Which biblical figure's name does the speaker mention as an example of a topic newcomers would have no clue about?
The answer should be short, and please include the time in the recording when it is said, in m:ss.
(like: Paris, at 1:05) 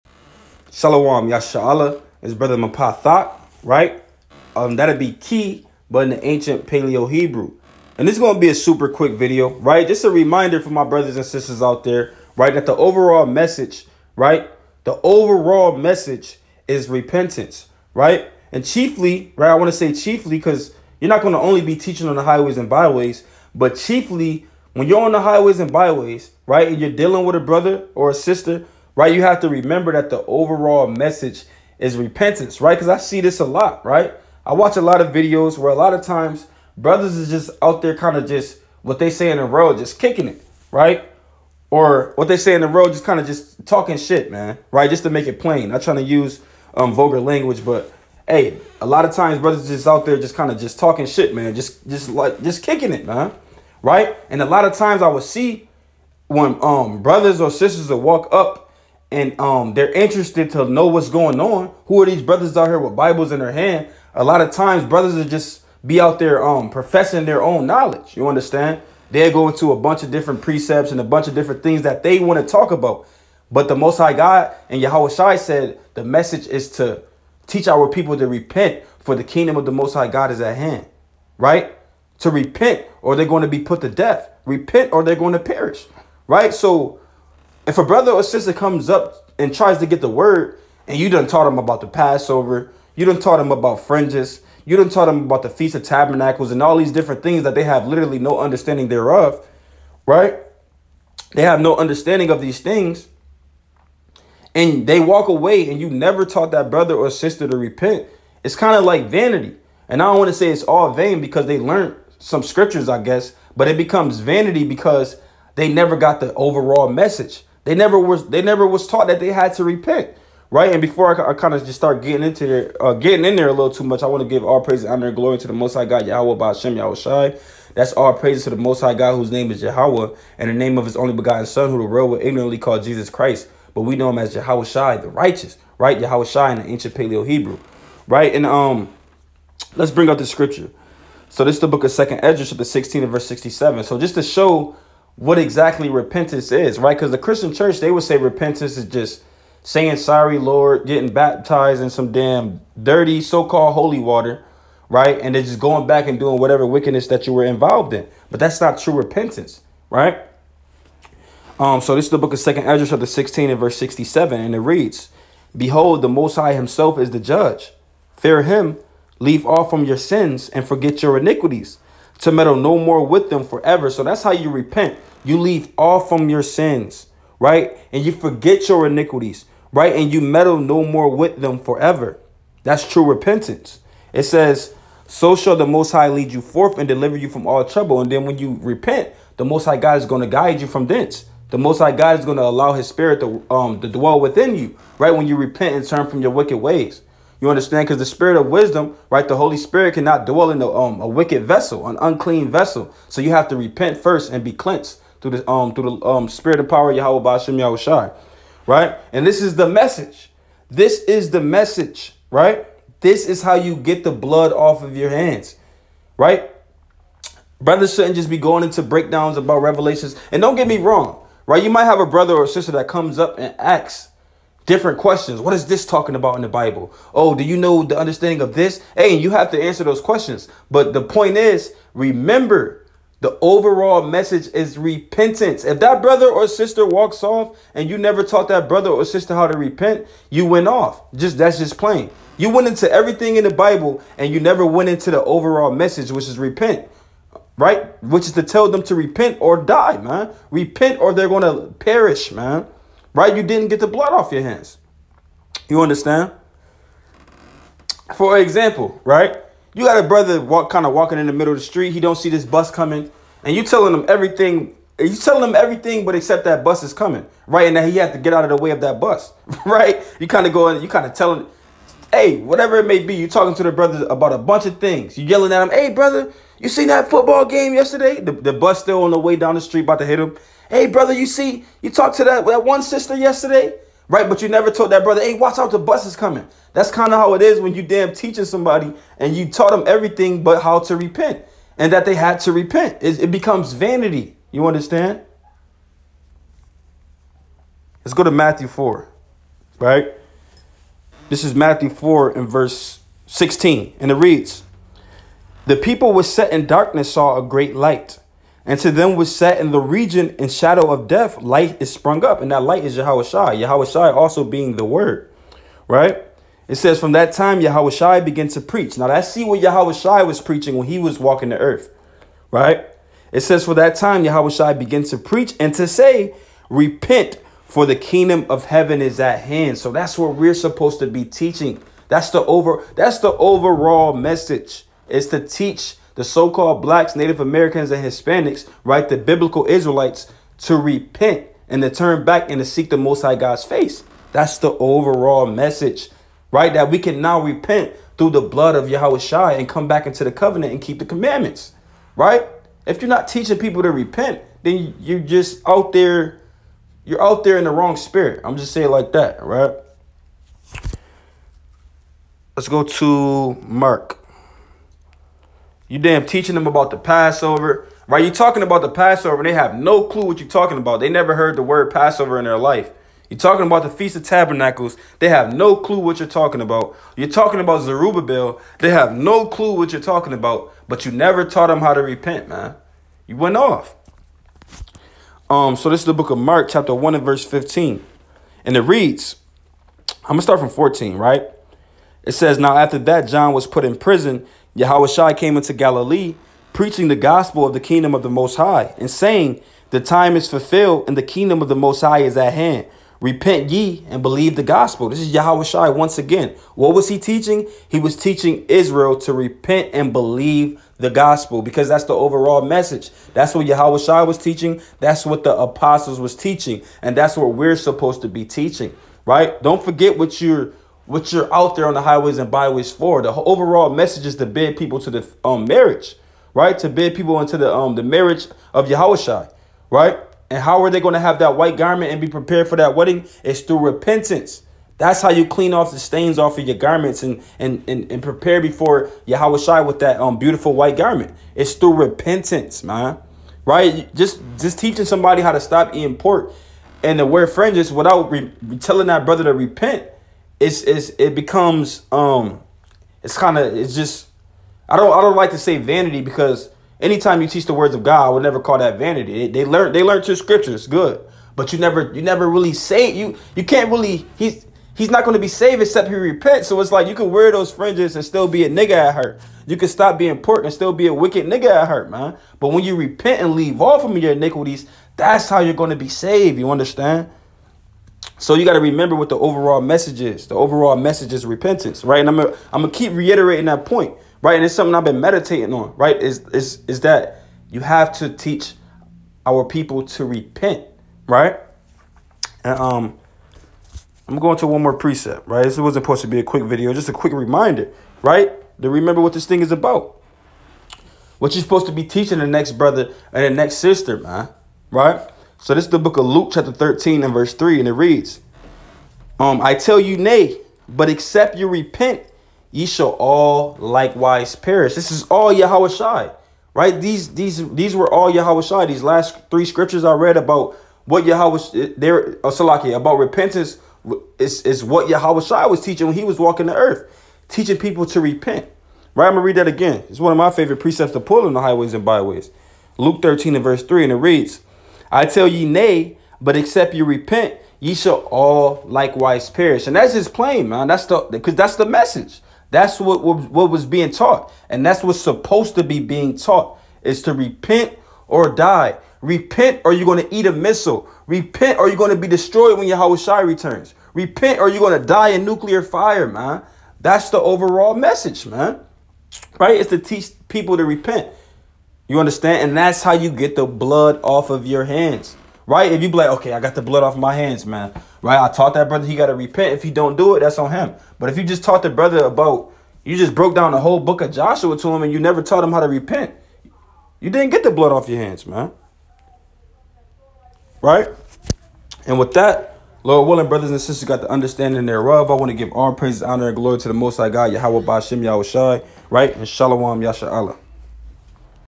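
Zerubbabel, at 6:17.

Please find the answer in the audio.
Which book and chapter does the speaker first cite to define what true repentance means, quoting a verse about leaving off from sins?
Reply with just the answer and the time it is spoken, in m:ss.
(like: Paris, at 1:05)
Second Ezra 16, at 2:21.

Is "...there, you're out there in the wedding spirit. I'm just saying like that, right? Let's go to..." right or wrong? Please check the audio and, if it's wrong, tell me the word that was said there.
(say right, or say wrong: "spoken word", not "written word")
wrong: "wrong", not "wedding".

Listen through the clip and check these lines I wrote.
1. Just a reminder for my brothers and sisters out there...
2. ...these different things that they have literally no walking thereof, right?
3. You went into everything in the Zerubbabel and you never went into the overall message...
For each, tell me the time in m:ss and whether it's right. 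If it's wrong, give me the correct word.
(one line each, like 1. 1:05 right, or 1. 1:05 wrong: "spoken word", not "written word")
1. 0:09 right
2. 1:36 wrong: "understanding", not "walking"
3. 4:02 wrong: "Bible", not "Zerubbabel".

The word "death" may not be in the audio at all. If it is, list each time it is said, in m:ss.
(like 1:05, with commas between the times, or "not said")
1:23, 5:11.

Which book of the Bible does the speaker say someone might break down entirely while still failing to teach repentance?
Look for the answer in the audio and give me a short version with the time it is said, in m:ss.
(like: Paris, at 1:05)
Joshua, at 9:34.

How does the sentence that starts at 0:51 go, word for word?
Just just like just kicking it, man, right?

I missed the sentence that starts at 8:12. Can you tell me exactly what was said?
And um, I'm going to one more precept, right?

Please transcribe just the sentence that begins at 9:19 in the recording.
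It's to teach people to repent.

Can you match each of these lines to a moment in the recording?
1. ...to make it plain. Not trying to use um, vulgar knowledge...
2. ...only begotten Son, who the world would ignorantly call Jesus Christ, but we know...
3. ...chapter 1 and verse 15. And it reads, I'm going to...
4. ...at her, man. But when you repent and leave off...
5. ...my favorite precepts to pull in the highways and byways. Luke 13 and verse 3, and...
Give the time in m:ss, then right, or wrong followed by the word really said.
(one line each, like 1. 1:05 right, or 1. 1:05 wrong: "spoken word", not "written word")
1. 0:45 wrong: "language", not "knowledge"
2. 2:10 right
3. 6:26 right
4. 7:51 right
5. 8:50 right.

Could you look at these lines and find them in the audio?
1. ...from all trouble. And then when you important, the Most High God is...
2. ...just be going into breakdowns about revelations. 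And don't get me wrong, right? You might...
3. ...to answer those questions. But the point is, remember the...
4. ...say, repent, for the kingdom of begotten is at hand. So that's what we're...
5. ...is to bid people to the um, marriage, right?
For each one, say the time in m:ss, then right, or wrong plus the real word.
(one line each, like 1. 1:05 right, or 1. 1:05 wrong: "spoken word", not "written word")
1. 3:07 wrong: "repent", not "important"
2. 3:38 right
3. 3:49 right
4. 5:25 wrong: "heaven", not "begotten"
5. 7:04 right.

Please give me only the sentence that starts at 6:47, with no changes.
He was teaching Israel to repent and believe the gospel because that's the overall message.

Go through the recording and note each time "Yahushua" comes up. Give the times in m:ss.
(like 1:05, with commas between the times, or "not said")
6:34, 6:45, 6:53, 7:08, 7:19.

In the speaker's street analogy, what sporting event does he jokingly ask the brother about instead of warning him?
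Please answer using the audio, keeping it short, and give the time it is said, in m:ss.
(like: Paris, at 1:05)
Football game, at 4:37.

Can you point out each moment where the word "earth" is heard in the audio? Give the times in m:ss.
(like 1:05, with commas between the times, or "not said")
5:21, 8:46.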